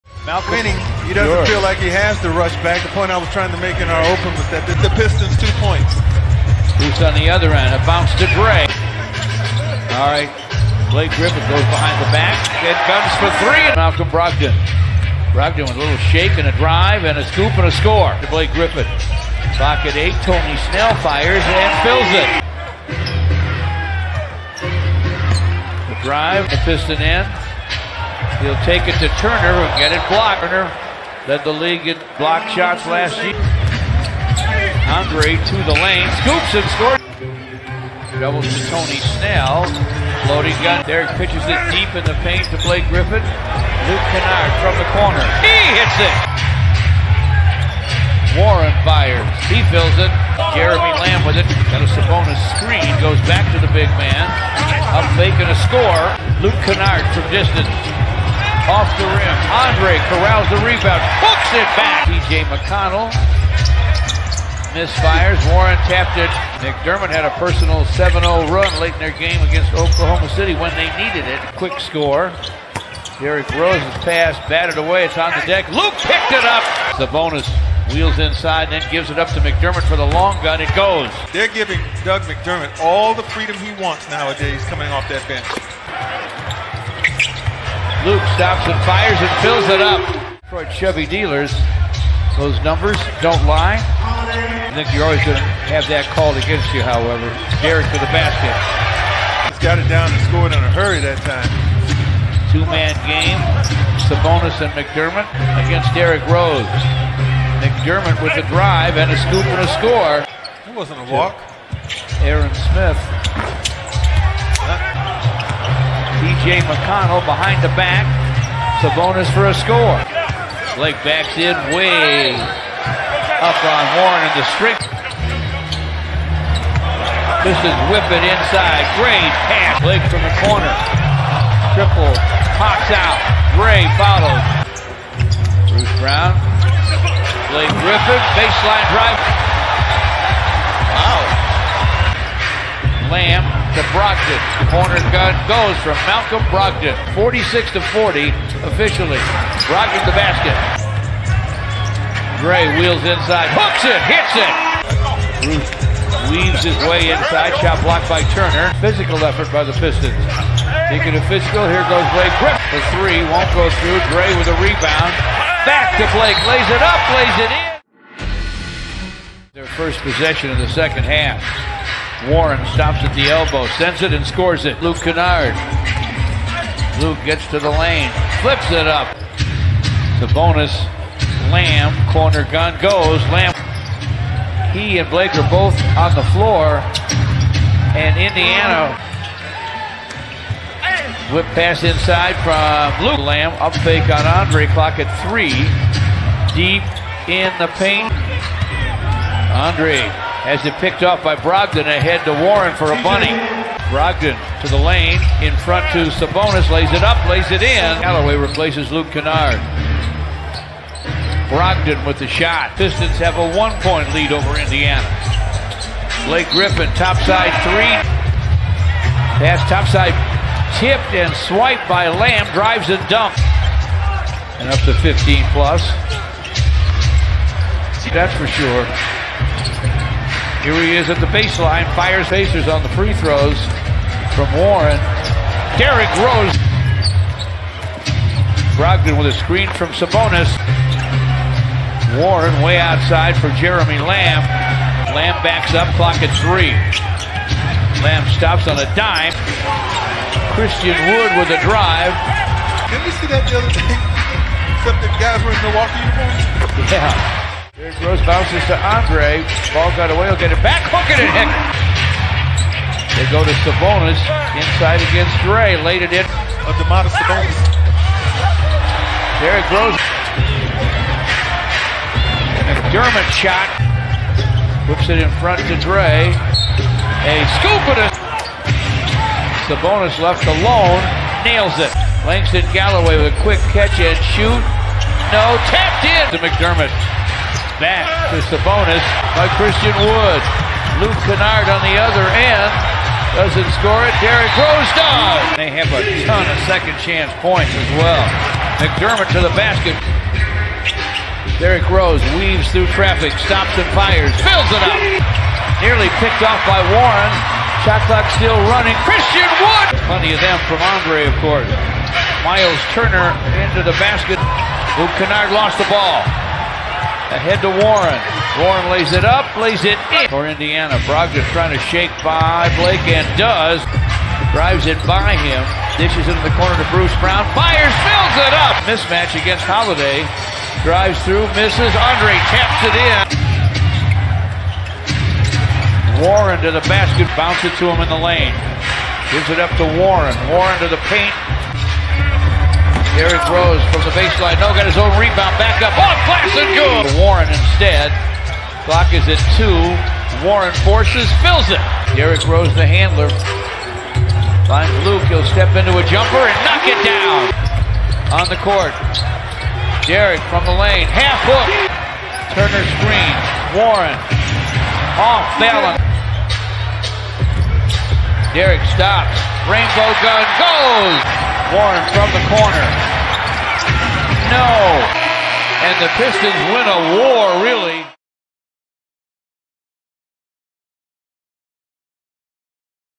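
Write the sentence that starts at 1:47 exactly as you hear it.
McDermott with the drive and a scoop and a score.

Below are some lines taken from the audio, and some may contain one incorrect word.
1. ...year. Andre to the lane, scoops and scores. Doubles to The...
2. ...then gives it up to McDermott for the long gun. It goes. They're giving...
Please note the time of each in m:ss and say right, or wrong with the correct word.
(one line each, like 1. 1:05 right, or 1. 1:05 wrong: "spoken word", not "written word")
1. 0:33 wrong: "Tony", not "The"
2. 1:18 right.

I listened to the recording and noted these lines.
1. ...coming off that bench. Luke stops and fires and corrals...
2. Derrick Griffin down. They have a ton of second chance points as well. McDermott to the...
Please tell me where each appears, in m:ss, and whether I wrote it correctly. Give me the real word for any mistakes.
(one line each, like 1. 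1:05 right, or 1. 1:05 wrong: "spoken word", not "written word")
1. 1:24 wrong: "fills", not "corrals"
2. 4:54 wrong: "Rose", not "Griffin".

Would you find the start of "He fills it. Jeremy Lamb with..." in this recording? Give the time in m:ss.
0:49.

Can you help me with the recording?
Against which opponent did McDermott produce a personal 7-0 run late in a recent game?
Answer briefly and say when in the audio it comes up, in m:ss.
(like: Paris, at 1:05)
Oklahoma City, at 1:09.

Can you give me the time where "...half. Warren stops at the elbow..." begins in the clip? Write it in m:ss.
2:51.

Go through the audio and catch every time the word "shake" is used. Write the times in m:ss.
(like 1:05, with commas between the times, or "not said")
0:16, 5:21.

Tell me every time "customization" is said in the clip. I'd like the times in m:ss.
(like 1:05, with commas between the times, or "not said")
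not said.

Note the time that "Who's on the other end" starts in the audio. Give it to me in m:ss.
0:06.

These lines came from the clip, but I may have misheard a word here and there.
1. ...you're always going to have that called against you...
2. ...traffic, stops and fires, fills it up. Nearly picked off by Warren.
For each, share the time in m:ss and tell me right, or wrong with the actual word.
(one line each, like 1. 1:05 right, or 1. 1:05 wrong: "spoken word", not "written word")
1. 1:34 right
2. 5:02 right.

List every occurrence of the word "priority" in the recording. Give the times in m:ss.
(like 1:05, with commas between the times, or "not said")
not said.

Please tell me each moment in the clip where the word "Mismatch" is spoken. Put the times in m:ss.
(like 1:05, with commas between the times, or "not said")
5:28.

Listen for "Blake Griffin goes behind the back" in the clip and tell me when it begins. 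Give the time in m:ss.
0:10.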